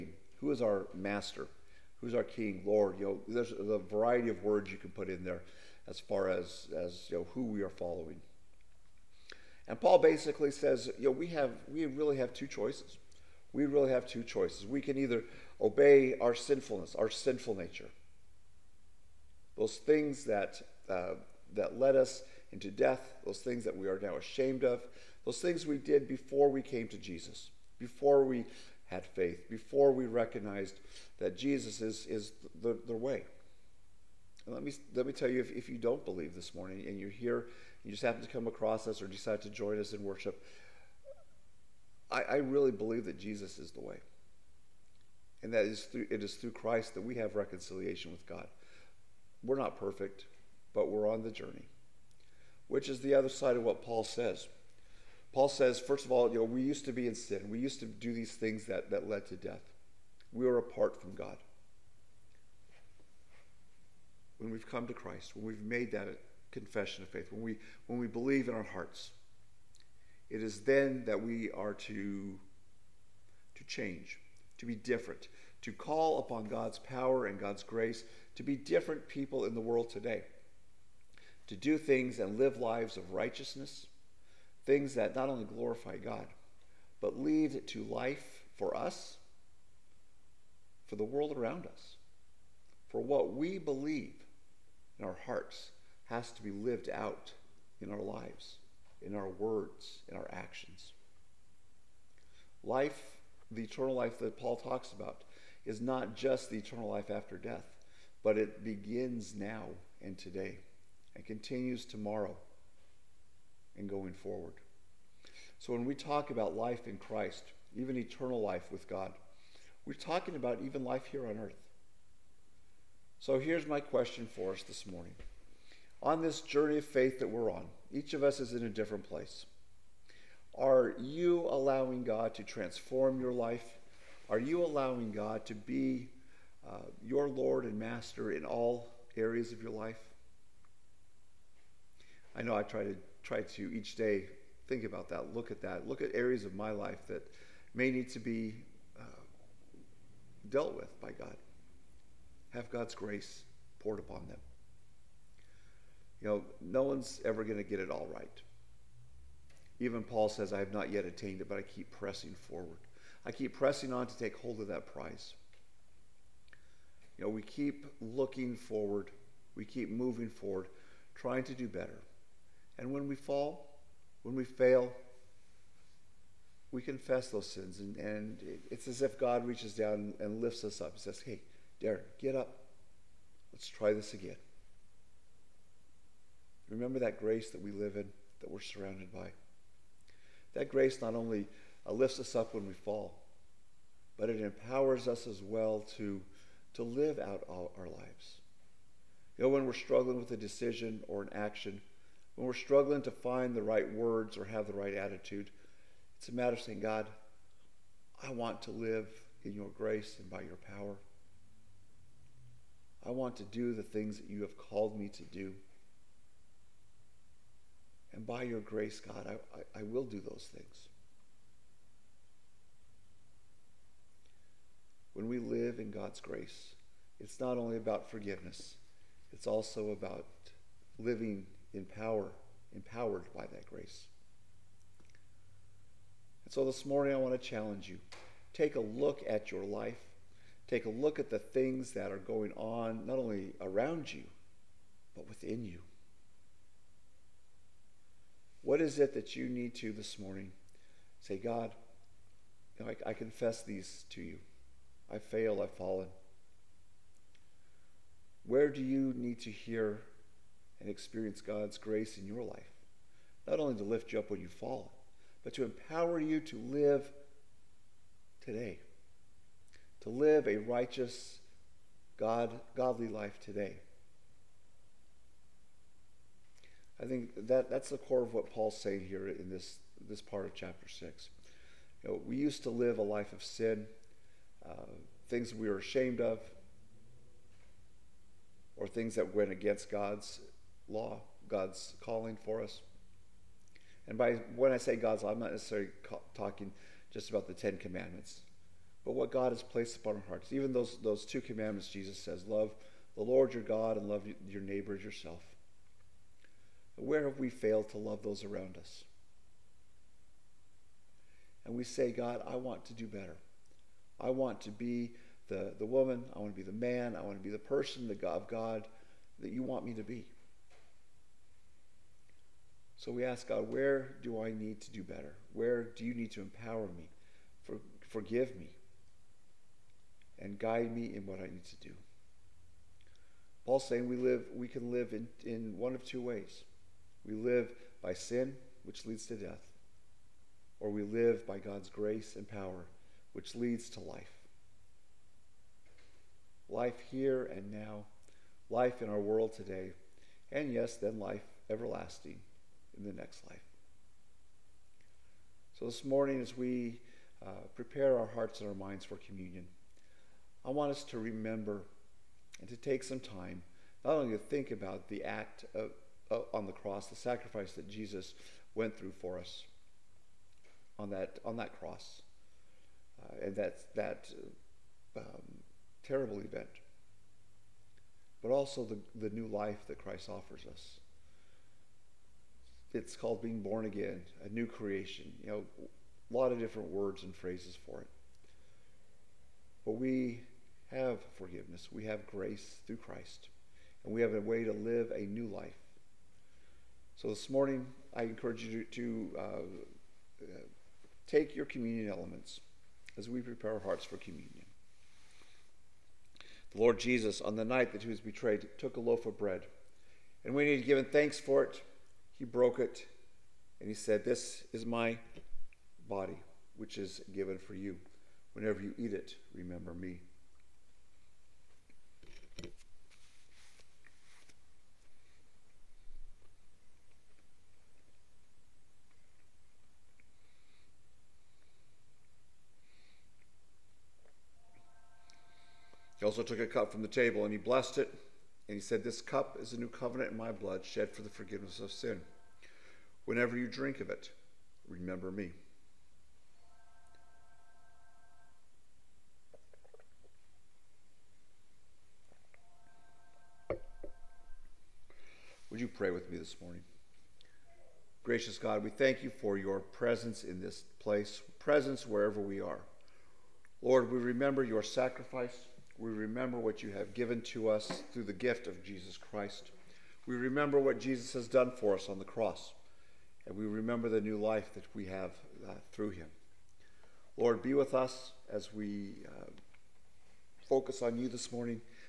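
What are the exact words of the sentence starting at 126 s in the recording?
On this journey of faith that we're on, each of us is in a different place.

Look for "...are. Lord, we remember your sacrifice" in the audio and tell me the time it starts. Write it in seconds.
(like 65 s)
462 s.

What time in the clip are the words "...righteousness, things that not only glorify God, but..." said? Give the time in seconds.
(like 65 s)
83 s.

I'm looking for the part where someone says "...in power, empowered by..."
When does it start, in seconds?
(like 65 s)
231 s.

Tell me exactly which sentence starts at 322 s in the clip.
So we ask God, where do I need to do better?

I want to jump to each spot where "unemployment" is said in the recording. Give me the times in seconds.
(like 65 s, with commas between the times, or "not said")
not said.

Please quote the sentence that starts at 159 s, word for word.
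Even Paul says, I have not yet attained it, but I keep pressing forward.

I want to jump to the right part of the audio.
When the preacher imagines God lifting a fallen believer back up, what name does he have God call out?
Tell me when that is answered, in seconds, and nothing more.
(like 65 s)
181 s.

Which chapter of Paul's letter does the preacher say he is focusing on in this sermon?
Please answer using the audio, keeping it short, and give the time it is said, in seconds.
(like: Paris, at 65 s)
Chapter 6, at 280 s.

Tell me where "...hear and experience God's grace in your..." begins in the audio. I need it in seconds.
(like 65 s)
259 s.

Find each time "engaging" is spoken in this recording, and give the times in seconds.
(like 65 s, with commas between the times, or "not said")
not said.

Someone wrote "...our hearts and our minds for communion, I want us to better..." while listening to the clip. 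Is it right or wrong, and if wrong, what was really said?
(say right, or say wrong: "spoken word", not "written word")
wrong: "remember", not "better".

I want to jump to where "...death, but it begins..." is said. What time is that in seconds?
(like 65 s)
107 s.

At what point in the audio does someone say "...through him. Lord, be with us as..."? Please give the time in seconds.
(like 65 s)
475 s.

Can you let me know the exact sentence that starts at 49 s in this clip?
We're not perfect, but we're on the journey, which is the other side of what Paul says.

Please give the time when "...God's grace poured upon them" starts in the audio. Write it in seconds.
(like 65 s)
152 s.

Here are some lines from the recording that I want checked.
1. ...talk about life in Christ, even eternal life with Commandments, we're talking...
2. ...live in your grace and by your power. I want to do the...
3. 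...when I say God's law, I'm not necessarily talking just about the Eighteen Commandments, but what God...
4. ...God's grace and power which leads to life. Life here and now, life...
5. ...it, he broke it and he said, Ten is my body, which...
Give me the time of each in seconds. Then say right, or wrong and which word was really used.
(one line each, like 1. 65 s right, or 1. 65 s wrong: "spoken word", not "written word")
1. 115 s wrong: "God", not "Commandments"
2. 208 s right
3. 294 s wrong: "Ten", not "Eighteen"
4. 341 s right
5. 411 s wrong: "This", not "Ten".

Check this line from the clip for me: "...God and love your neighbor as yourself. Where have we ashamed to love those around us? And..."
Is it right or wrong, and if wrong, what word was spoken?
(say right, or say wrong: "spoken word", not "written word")
wrong: "failed", not "ashamed".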